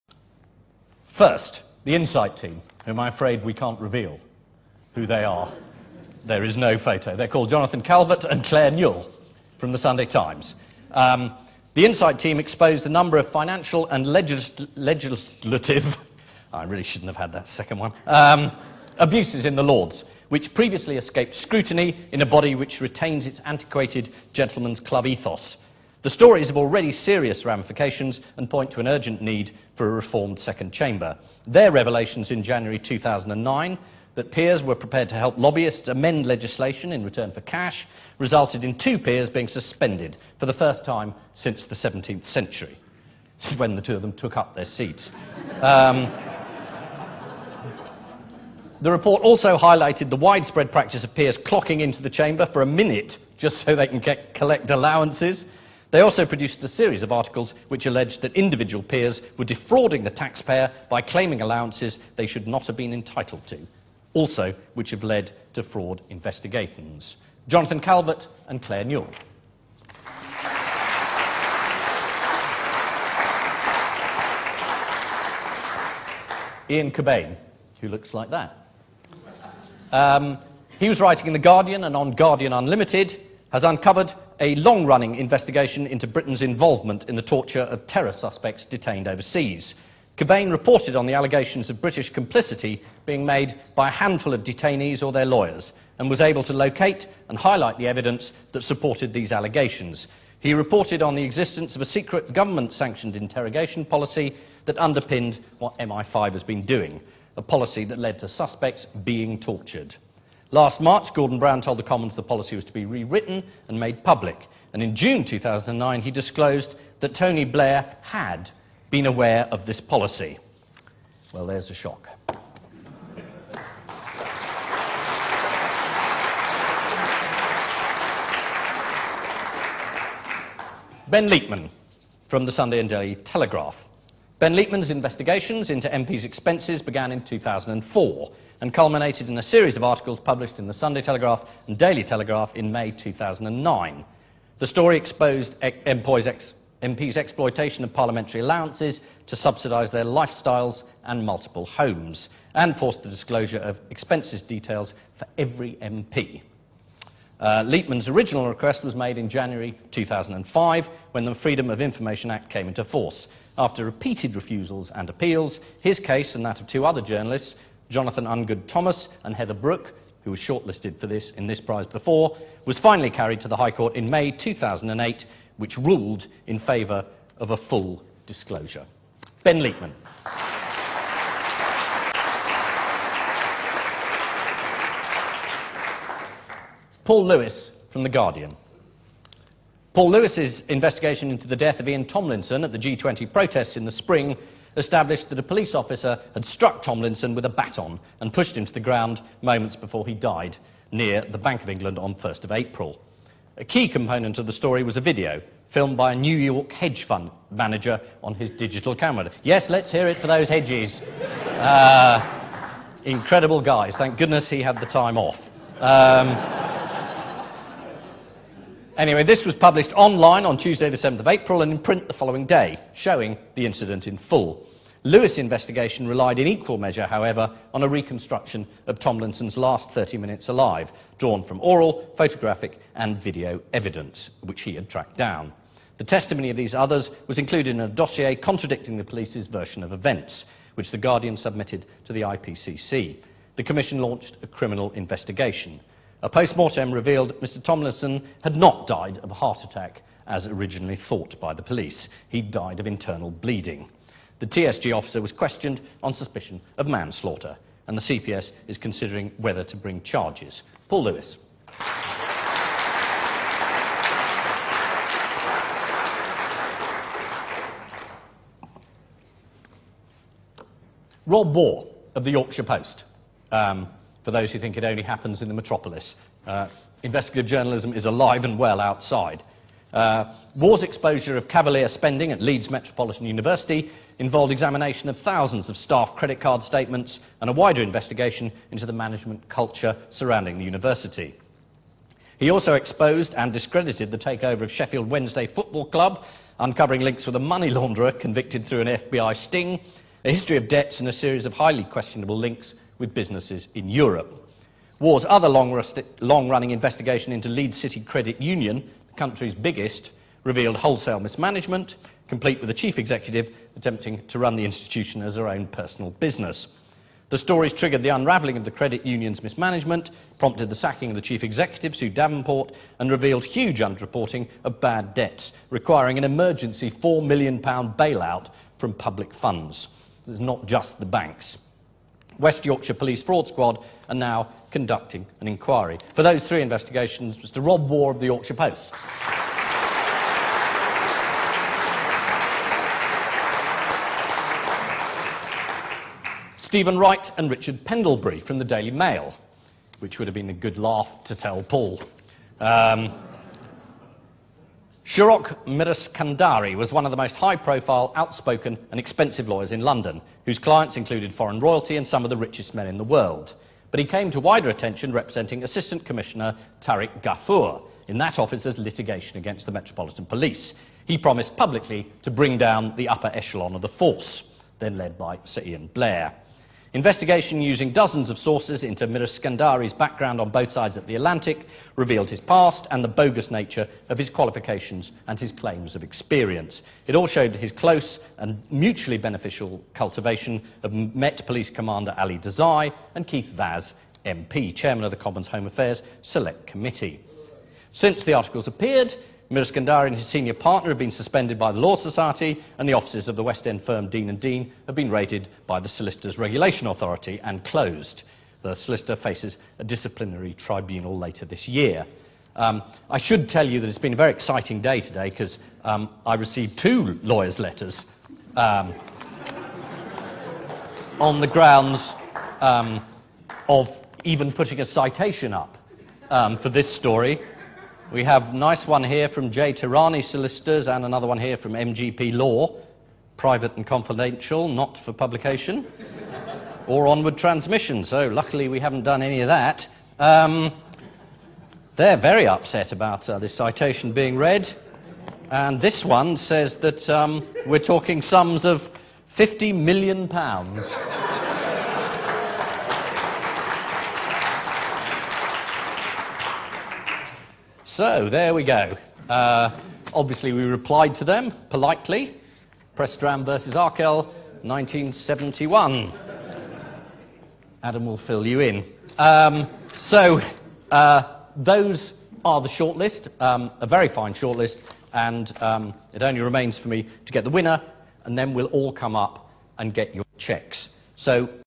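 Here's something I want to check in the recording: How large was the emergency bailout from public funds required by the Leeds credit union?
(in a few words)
£4 million.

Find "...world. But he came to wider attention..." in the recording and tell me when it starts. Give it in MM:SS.
06:03.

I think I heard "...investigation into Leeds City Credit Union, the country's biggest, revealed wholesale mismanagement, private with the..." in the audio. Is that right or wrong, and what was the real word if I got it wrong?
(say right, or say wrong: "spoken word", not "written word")
wrong: "complete", not "private".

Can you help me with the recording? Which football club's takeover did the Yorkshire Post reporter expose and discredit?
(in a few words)
Sheffield Wednesday.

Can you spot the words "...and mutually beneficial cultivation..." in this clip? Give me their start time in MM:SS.
06:28.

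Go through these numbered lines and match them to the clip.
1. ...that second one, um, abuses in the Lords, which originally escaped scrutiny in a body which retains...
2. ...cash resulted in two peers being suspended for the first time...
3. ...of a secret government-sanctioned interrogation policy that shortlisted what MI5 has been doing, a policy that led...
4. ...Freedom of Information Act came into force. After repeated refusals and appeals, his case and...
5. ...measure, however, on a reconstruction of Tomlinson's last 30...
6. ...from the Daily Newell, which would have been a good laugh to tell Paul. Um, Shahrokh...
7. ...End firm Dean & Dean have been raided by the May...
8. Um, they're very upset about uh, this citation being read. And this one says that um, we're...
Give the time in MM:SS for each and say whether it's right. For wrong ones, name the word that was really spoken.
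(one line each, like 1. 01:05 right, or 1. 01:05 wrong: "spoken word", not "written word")
1. 00:17 wrong: "previously", not "originally"
2. 00:37 right
3. 01:41 wrong: "underpinned", not "shortlisted"
4. 02:41 right
5. 03:46 right
6. 05:48 wrong: "Mail", not "Newell"
7. 06:43 wrong: "Solicitors", not "May"
8. 07:20 right.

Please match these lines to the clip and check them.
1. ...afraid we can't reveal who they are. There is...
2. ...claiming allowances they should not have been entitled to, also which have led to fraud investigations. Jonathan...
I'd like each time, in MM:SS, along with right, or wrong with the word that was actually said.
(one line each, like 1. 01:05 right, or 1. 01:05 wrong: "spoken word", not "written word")
1. 00:03 right
2. 01:01 right.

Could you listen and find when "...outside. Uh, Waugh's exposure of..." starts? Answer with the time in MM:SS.
04:38.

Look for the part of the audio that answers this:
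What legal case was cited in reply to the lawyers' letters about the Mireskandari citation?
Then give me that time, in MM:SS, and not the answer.
07:42.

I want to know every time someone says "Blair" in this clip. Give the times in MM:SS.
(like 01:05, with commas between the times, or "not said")
01:57, 06:15.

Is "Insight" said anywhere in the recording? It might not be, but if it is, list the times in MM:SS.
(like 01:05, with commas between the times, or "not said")
00:01, 00:11.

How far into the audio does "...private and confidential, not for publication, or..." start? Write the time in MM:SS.
07:13.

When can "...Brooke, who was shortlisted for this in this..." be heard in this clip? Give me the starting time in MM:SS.
02:49.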